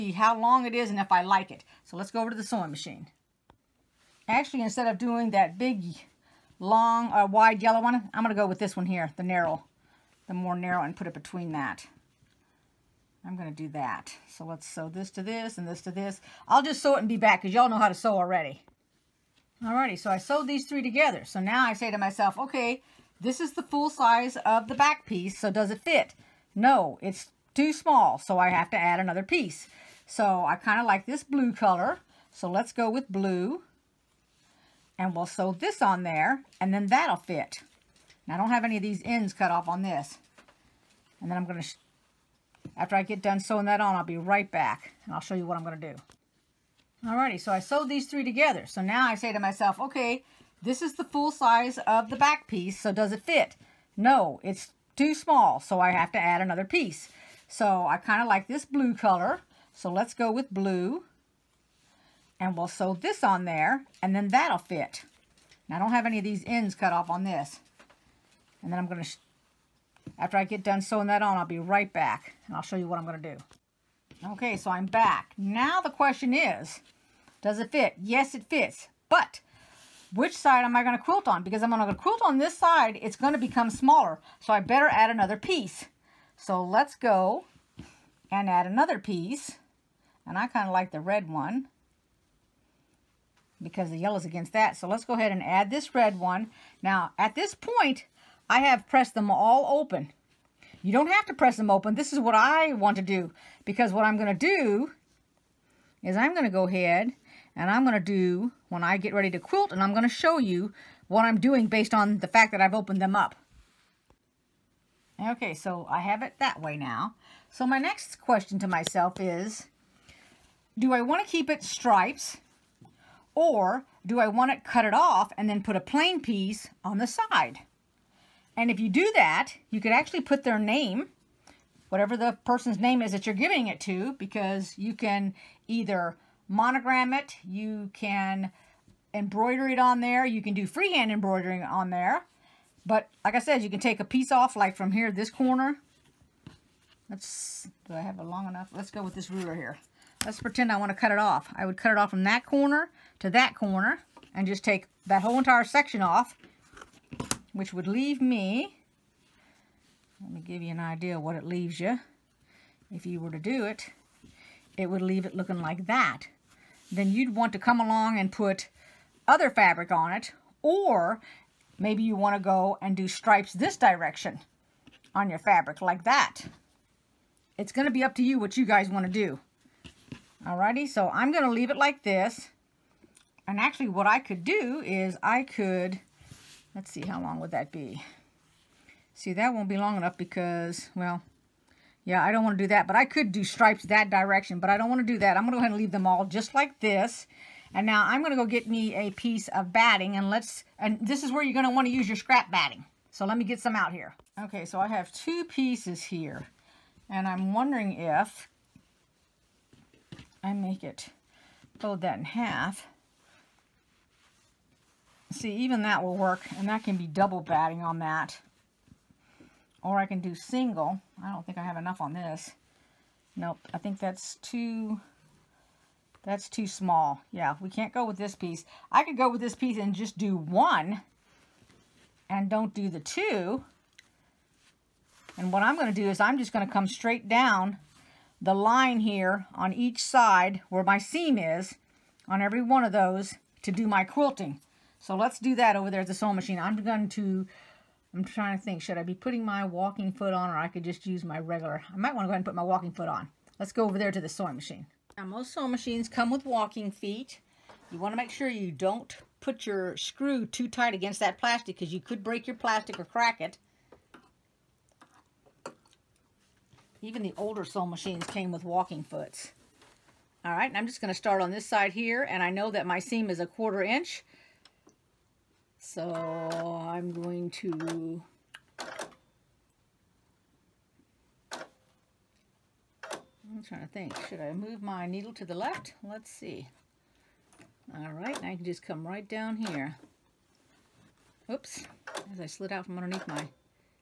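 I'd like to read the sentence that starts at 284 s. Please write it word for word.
Should I move my needle to the left?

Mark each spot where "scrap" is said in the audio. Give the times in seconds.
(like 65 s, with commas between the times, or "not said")
202 s.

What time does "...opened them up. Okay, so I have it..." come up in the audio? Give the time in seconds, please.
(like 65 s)
112 s.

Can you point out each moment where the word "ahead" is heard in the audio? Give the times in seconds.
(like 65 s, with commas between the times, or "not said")
95 s, 106 s, 195 s, 252 s.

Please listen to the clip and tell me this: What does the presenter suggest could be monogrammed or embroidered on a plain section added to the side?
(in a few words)
Their name.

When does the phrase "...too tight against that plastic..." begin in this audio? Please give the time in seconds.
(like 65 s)
260 s.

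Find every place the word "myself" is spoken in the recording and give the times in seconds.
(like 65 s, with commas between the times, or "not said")
21 s, 49 s, 118 s.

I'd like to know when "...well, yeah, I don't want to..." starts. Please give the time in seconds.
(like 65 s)
190 s.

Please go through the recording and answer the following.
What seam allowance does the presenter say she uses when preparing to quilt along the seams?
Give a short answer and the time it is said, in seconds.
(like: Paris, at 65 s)
A quarter inch, at 273 s.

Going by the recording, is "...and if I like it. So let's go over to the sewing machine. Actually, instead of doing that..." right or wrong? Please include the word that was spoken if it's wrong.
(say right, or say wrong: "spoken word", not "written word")
right.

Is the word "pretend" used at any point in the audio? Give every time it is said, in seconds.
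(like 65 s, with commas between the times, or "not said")
150 s.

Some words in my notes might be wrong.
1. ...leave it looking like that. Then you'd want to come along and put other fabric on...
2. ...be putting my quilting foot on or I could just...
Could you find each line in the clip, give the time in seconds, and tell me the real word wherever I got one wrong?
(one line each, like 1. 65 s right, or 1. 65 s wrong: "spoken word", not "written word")
1. 165 s right
2. 249 s wrong: "walking", not "quilting".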